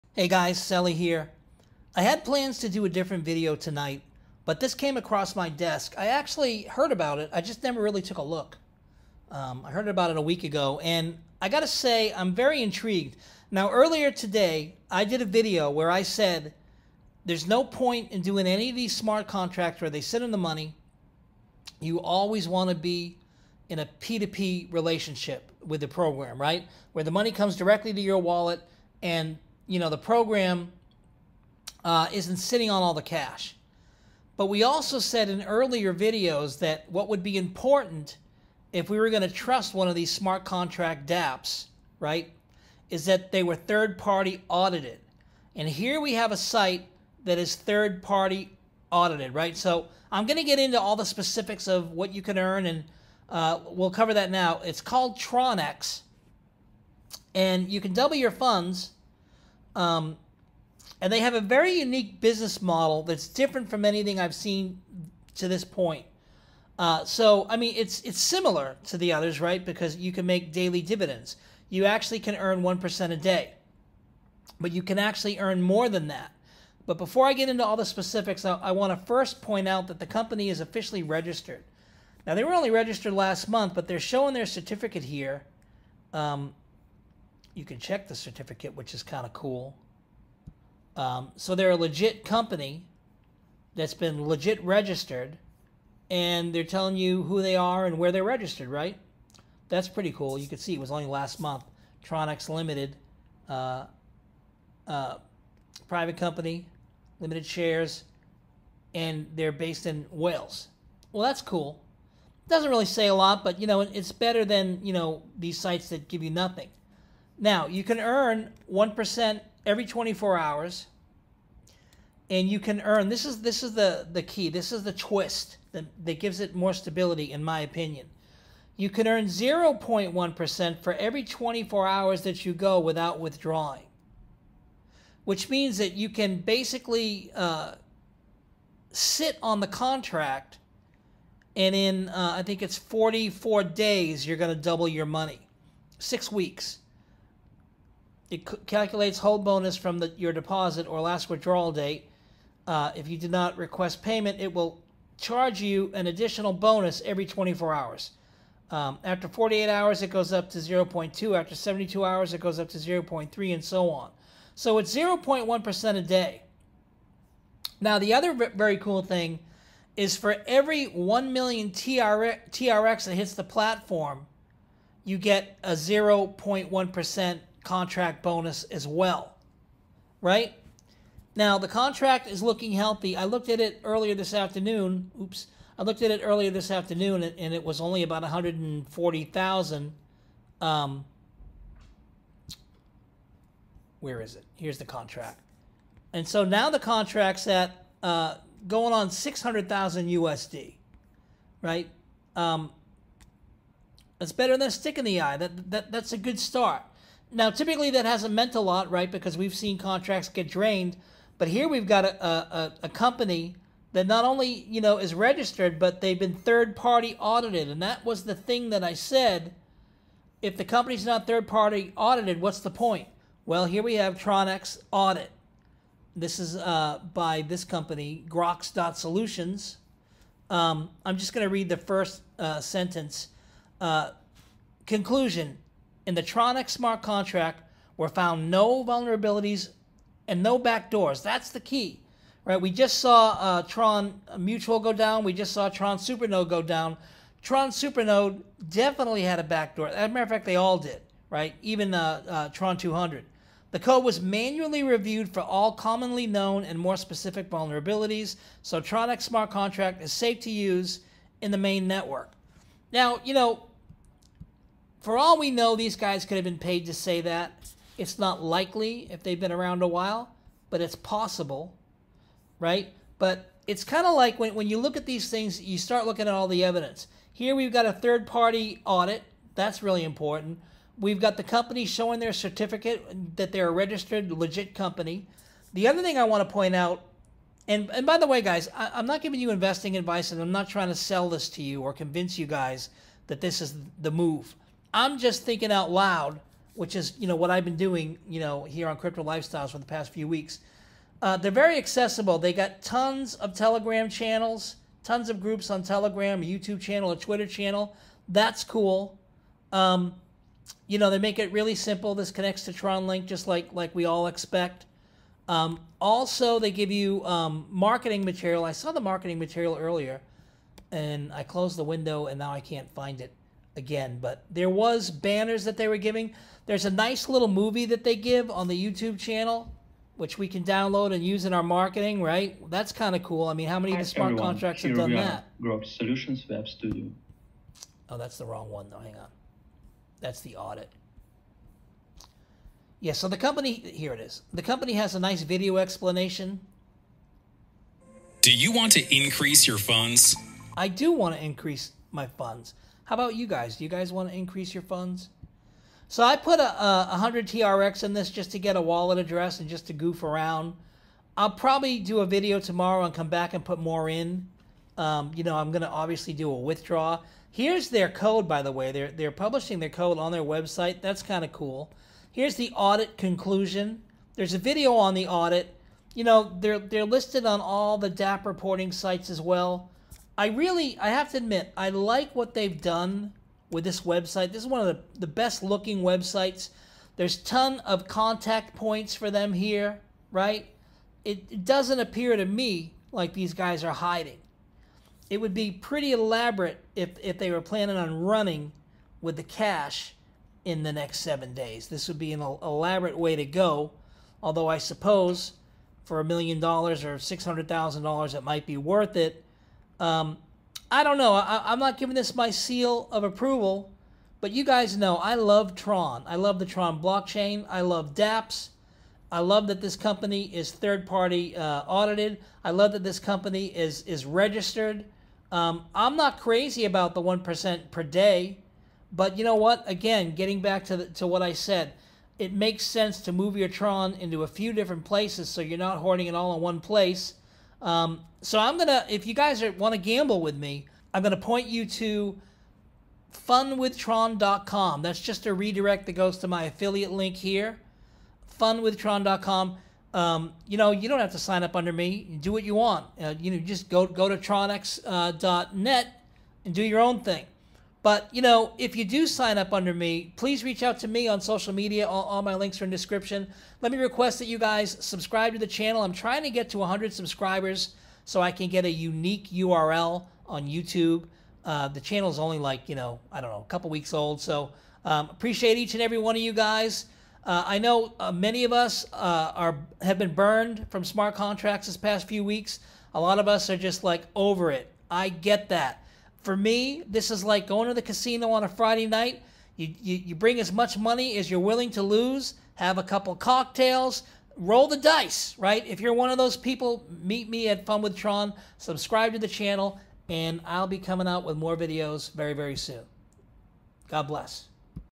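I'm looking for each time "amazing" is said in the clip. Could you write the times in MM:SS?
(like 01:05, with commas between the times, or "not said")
not said.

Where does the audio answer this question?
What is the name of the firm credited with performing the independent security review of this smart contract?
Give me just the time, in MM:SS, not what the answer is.
03:48.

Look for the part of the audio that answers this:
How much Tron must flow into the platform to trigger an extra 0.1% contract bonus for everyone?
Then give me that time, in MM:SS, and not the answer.
02:50.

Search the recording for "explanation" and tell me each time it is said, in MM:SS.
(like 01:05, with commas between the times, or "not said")
05:45.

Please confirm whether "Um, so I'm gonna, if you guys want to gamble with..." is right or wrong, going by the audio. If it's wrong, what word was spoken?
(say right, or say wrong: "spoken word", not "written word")
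right.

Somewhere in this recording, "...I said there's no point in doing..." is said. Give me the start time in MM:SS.
00:15.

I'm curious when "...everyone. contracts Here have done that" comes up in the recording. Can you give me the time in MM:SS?
05:34.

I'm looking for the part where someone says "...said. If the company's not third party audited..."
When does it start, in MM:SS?
03:38.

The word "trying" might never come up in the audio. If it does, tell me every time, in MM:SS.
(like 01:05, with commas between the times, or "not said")
04:50, 07:46.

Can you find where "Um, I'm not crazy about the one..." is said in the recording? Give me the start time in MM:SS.
07:05.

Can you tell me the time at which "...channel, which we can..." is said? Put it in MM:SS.
05:29.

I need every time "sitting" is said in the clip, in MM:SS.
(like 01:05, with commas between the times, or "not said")
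00:32.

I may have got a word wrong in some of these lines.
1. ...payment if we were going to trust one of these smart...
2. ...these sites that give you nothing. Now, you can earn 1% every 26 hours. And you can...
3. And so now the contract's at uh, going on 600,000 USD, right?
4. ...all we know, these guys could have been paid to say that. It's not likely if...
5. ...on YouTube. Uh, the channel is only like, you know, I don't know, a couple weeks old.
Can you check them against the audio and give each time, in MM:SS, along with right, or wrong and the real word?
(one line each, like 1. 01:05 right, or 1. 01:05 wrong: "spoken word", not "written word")
1. 00:37 wrong: "important", not "payment"
2. 01:55 wrong: "24", not "26"
3. 03:16 right
4. 04:25 right
5. 07:50 right.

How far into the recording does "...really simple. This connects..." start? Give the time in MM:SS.
05:11.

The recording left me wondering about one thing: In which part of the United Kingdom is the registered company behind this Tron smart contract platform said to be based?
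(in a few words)
Wales.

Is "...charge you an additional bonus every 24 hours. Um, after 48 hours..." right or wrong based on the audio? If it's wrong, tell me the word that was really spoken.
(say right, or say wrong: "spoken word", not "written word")
right.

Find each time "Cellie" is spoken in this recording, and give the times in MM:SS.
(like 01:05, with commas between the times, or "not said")
00:00.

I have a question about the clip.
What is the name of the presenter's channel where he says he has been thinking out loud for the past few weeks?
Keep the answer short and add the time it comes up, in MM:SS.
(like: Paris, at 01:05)
Crypto Lifestyles, at 04:58.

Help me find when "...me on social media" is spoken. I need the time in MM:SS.
07:41.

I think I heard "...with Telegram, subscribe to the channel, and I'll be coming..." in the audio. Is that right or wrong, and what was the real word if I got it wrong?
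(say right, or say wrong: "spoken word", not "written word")
wrong: "Tron", not "Telegram".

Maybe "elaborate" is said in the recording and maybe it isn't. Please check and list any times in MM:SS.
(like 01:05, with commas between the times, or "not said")
06:36, 06:42.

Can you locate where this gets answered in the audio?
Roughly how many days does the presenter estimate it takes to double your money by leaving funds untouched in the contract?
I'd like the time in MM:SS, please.
02:22.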